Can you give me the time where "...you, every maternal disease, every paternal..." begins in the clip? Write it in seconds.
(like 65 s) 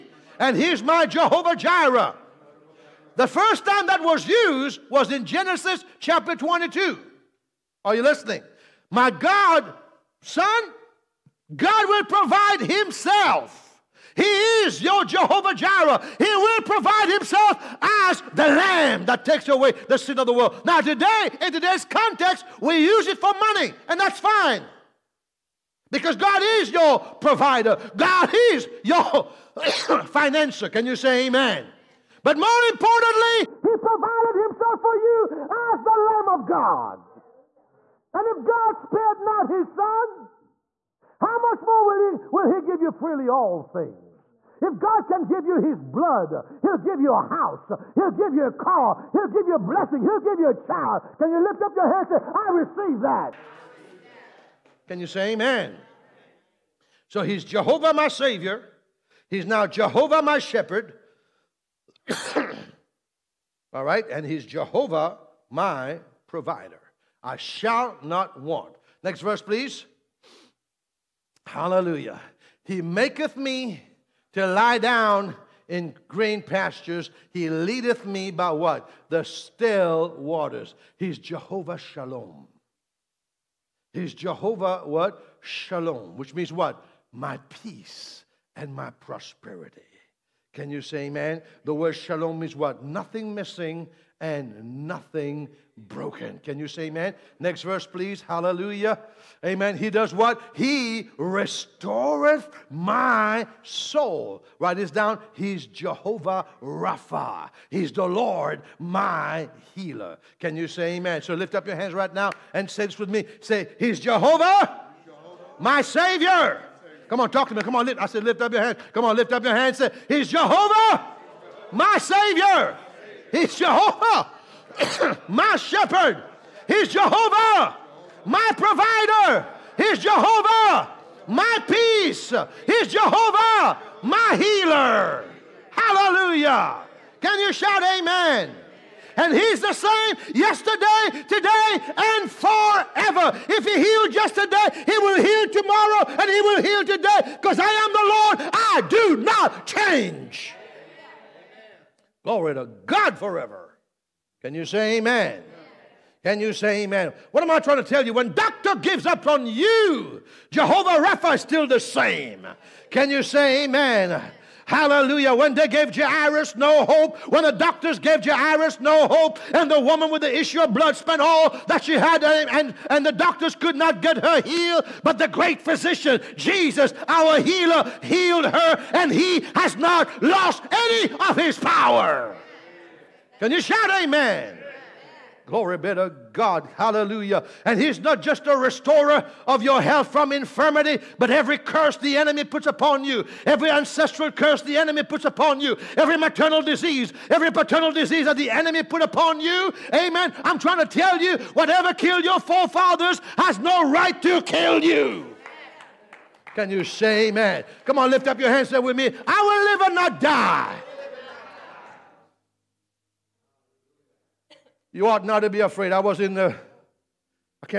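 195 s.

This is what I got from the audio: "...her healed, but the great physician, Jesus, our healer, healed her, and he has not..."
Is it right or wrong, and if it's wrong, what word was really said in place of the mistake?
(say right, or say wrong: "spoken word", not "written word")
right.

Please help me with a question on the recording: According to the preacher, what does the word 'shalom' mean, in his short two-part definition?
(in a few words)
Nothing missing and nothing broken.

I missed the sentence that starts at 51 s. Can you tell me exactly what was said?
Can you lift up your hand and say, I receive that?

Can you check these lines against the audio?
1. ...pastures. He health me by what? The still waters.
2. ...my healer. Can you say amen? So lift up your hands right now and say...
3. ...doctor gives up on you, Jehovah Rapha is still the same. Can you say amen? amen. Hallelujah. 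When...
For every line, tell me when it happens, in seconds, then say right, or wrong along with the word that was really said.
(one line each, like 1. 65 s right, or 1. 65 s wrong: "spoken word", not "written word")
1. 76 s wrong: "leadeth", not "health"
2. 108 s right
3. 158 s right.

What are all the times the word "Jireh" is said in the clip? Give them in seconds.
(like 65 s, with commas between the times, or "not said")
1 s, 15 s.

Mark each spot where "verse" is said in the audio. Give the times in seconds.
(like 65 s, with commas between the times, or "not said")
69 s, 97 s.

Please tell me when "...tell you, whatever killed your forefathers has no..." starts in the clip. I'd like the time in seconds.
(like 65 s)
200 s.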